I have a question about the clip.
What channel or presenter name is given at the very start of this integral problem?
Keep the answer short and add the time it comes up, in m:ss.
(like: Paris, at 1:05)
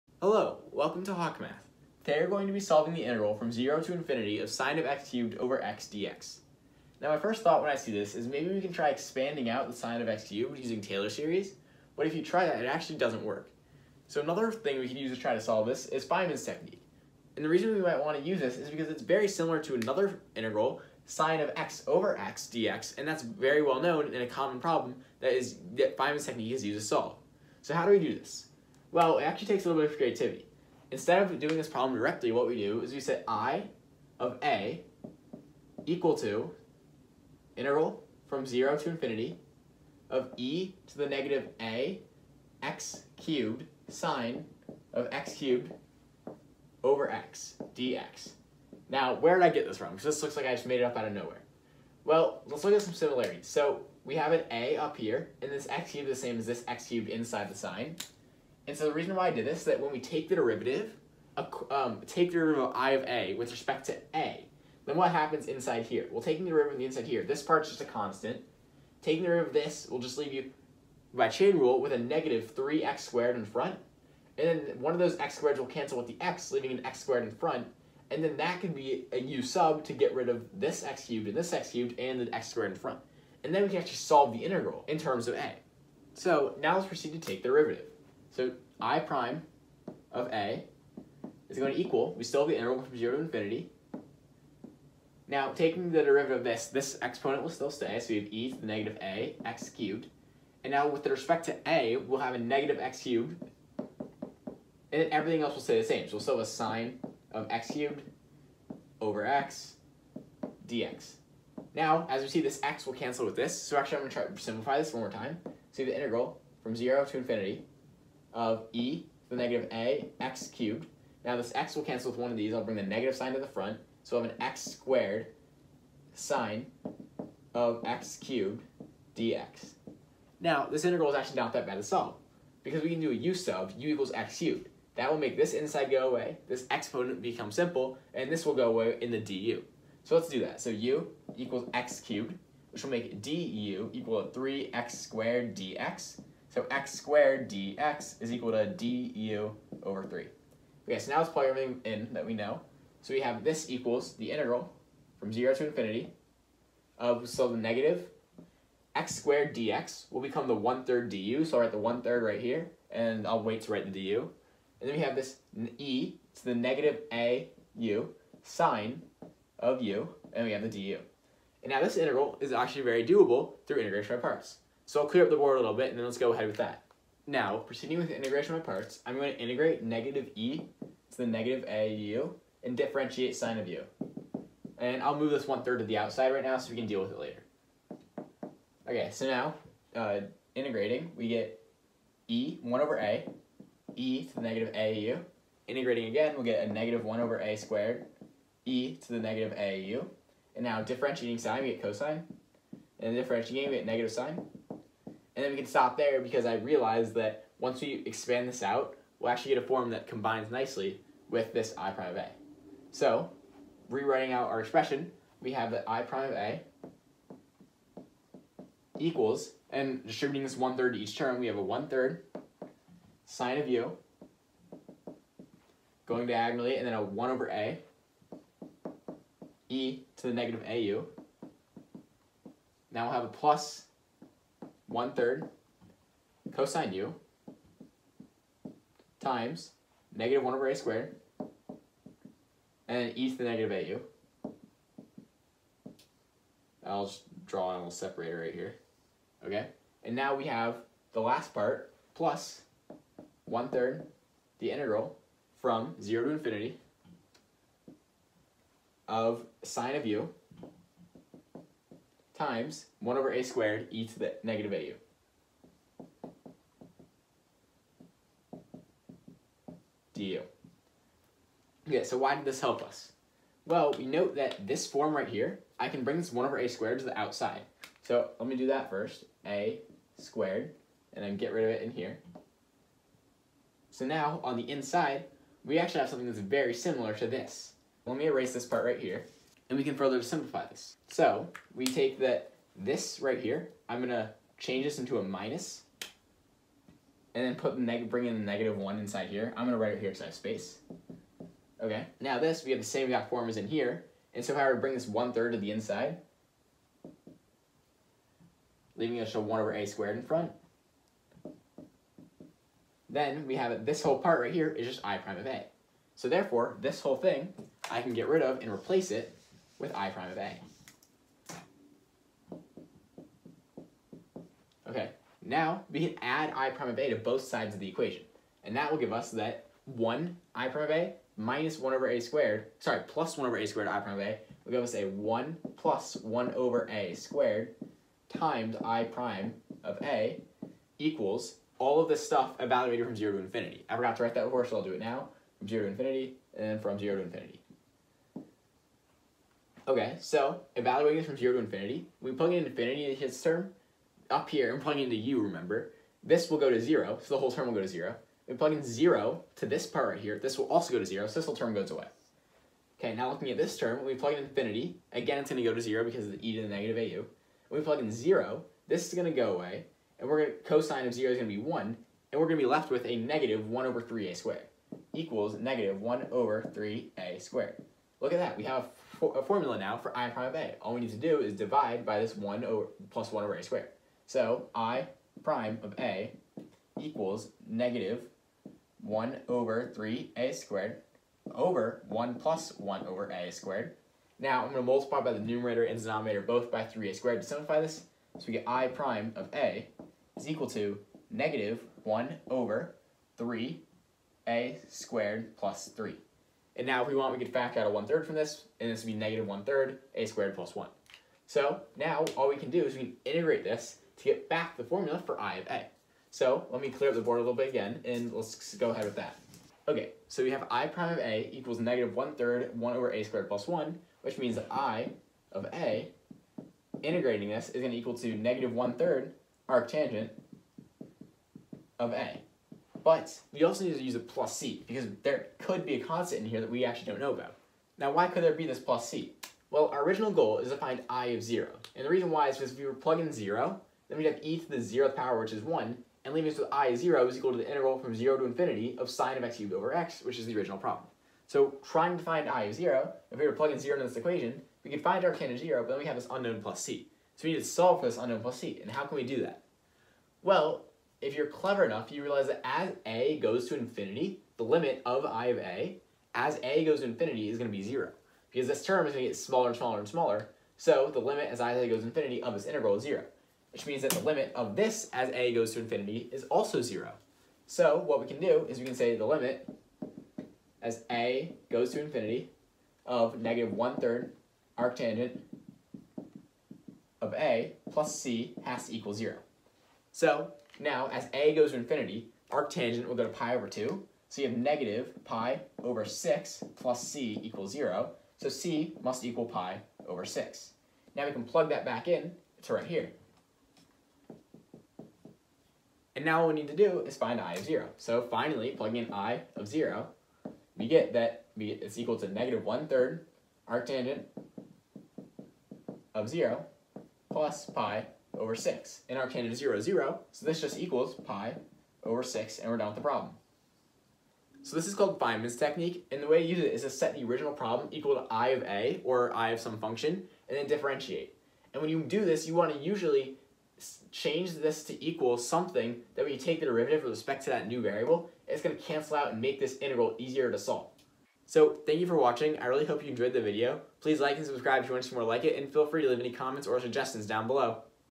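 Hawk Math, at 0:01.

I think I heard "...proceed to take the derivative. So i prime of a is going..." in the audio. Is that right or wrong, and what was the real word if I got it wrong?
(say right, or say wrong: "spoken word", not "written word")
right.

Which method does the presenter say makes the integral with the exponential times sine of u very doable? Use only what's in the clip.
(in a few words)
integration by parts.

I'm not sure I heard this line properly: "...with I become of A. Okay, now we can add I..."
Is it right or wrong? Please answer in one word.
wrong.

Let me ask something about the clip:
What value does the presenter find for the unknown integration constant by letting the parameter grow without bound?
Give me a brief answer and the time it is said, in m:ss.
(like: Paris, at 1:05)
pi/6, at 8:18.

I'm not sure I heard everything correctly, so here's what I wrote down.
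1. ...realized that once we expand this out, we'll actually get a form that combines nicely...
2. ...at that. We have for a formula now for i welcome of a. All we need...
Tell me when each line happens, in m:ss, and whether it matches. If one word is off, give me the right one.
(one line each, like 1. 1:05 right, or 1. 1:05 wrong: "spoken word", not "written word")
1. 3:26 right
2. 6:18 wrong: "prime", not "welcome".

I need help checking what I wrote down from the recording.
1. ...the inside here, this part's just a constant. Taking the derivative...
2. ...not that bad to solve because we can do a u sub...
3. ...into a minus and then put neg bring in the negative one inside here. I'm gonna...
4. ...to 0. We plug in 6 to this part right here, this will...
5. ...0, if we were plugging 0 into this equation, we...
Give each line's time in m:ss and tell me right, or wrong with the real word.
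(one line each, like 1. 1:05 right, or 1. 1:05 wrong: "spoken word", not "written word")
1. 1:06 right
2. 2:11 right
3. 4:54 right
4. 5:57 wrong: "0", not "6"
5. 7:32 right.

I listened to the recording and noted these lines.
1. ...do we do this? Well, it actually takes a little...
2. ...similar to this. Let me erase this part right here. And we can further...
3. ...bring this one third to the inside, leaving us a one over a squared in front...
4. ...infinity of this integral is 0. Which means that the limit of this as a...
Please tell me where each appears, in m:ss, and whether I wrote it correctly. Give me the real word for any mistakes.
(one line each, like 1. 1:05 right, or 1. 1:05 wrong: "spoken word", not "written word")
1. 0:27 right
2. 4:46 right
3. 5:04 right
4. 7:52 right.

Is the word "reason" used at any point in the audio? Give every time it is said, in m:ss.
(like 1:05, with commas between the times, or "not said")
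0:17, 0:58, 7:22.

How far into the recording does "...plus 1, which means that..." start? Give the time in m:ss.
7:03.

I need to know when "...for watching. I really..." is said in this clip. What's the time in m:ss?
9:02.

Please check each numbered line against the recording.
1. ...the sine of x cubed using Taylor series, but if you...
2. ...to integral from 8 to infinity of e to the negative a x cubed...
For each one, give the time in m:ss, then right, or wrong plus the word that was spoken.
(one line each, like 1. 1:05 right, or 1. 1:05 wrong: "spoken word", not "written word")
1. 0:09 right
2. 0:36 wrong: "0", not "8".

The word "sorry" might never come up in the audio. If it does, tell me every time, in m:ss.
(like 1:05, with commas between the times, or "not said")
5:32.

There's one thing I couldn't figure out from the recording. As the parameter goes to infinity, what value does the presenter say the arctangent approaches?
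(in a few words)
pi/2.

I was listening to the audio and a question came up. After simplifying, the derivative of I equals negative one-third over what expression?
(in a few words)
a^2 + 1.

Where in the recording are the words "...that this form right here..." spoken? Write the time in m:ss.
4:34.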